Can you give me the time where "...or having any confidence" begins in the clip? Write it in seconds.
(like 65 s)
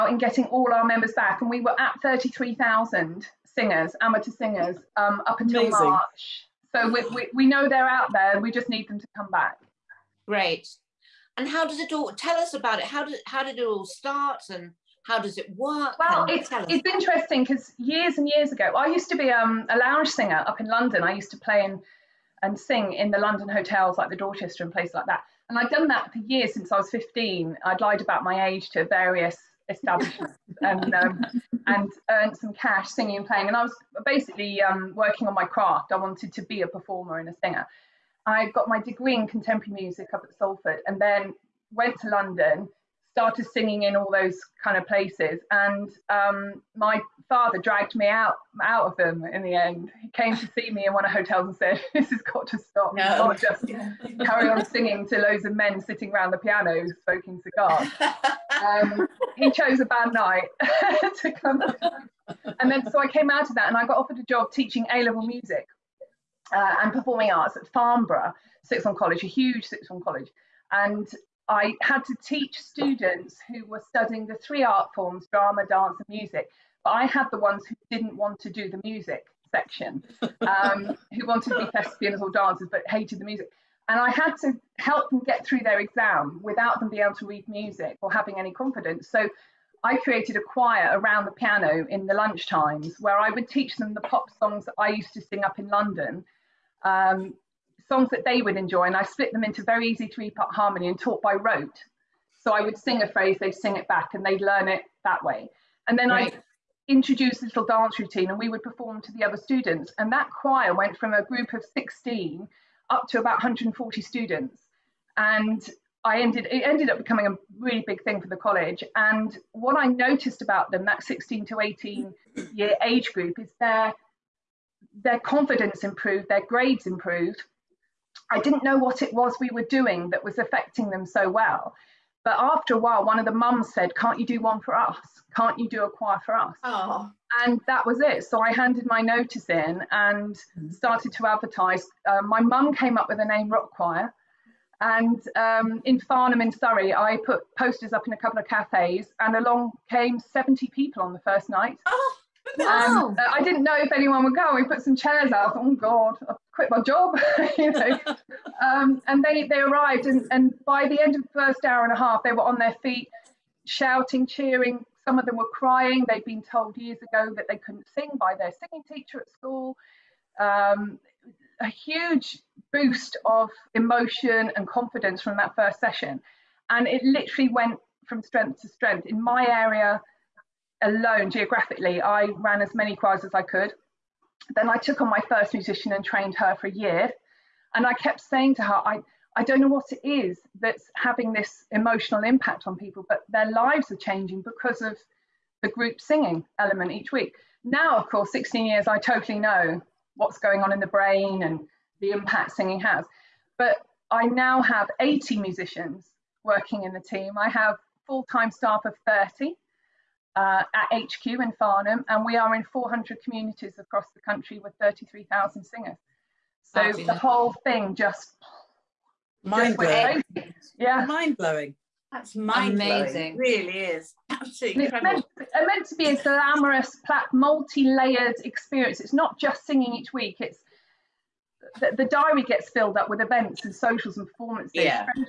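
88 s.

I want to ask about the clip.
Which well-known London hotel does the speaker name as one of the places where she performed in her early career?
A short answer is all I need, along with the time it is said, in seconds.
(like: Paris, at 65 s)
Dorchester, at 24 s.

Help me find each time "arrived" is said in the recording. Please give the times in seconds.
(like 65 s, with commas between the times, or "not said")
159 s.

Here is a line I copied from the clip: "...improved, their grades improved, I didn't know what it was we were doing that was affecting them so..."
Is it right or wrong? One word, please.
right.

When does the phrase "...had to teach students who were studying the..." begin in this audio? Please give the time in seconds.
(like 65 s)
71 s.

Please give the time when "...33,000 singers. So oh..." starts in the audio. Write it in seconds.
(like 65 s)
214 s.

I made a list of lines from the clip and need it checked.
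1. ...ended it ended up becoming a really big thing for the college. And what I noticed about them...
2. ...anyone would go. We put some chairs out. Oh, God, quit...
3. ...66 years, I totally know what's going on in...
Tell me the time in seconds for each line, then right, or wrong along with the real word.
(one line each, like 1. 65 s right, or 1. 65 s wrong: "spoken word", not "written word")
1. 116 s right
2. 153 s right
3. 198 s wrong: "16", not "66".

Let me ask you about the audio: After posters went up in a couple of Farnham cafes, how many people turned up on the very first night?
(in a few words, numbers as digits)
70.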